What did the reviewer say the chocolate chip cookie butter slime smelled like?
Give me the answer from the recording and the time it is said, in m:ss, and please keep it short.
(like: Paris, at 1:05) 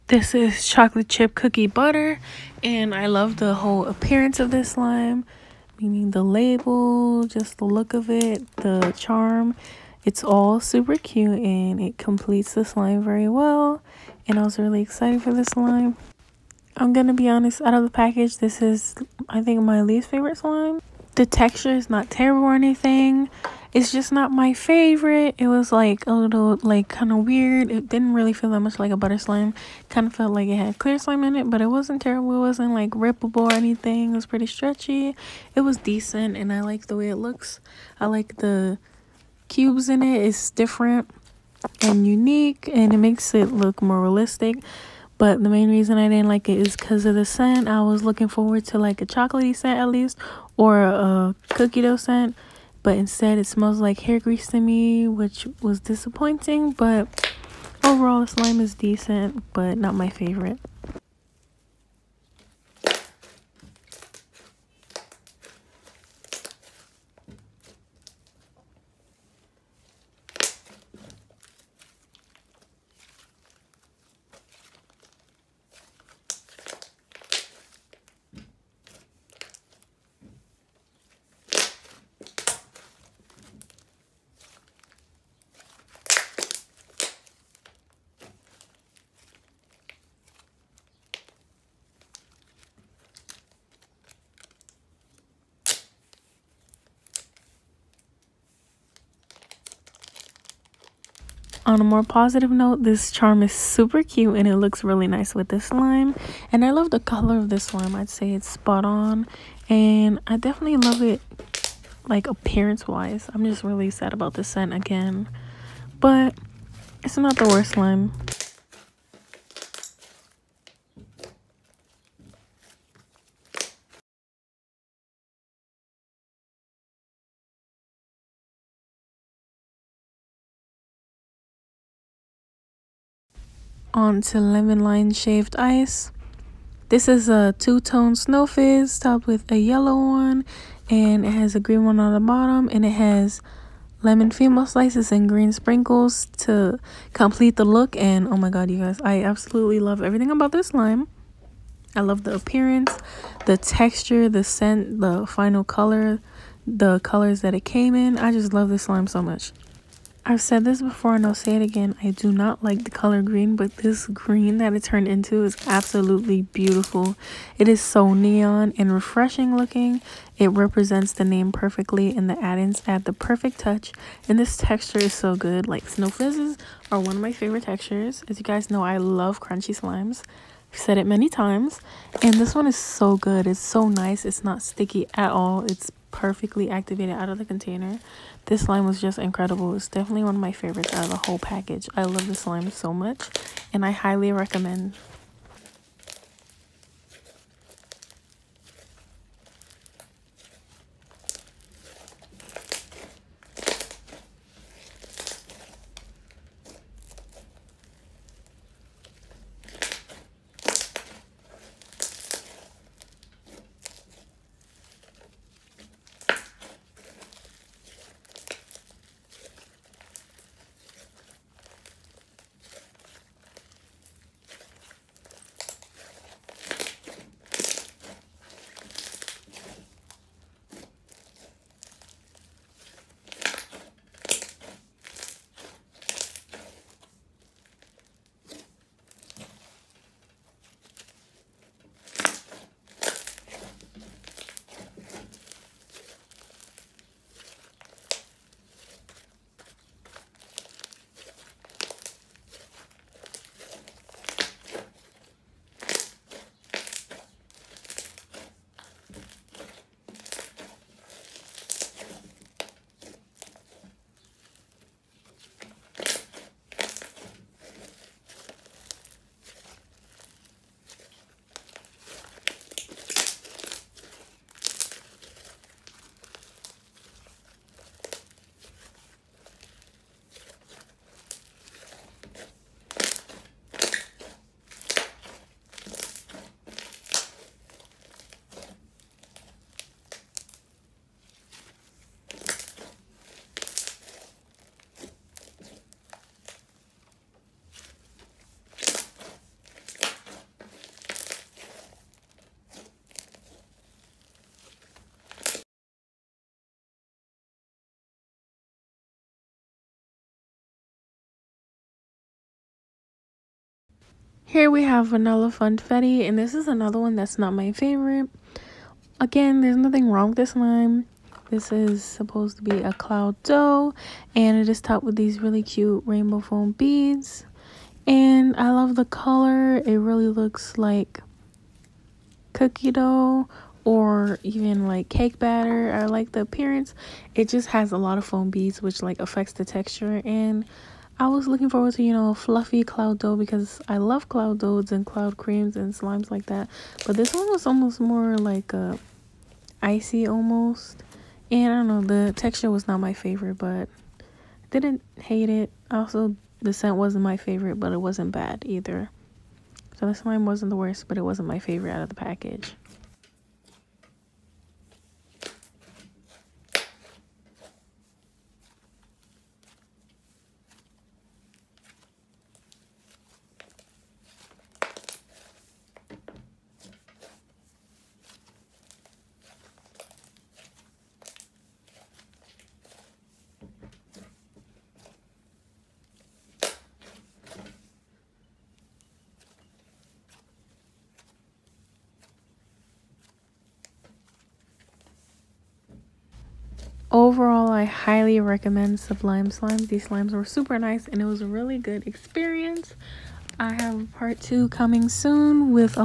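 hair grease, at 0:54.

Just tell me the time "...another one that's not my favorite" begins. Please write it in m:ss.
5:16.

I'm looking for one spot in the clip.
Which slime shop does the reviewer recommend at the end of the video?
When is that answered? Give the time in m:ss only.
6:38.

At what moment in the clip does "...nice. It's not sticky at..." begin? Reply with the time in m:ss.
3:03.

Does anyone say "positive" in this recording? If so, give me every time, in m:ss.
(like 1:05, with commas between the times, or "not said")
1:42.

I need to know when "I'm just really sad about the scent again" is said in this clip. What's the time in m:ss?
1:53.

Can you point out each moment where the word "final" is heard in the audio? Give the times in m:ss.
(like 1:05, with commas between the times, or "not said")
2:35.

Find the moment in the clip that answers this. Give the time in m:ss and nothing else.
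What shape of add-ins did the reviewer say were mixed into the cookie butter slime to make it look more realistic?
0:39.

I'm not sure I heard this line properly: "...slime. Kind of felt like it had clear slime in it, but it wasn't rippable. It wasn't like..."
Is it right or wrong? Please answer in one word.
wrong.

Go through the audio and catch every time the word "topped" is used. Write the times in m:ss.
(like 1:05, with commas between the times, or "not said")
2:18, 5:24.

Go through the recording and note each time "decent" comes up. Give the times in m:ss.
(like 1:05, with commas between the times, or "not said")
0:35, 0:58.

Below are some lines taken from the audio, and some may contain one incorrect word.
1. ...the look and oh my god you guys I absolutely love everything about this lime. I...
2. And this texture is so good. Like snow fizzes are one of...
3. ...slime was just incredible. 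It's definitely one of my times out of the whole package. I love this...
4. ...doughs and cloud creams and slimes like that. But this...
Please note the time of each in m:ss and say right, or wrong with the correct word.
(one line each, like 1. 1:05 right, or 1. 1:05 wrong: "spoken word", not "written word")
1. 2:27 right
2. 2:54 right
3. 3:08 wrong: "favorites", not "times"
4. 5:44 right.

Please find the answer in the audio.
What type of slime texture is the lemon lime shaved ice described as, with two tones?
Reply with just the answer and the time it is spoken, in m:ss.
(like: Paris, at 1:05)
snow fizz, at 2:18.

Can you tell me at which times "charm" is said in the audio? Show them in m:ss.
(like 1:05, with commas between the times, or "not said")
0:08, 1:43.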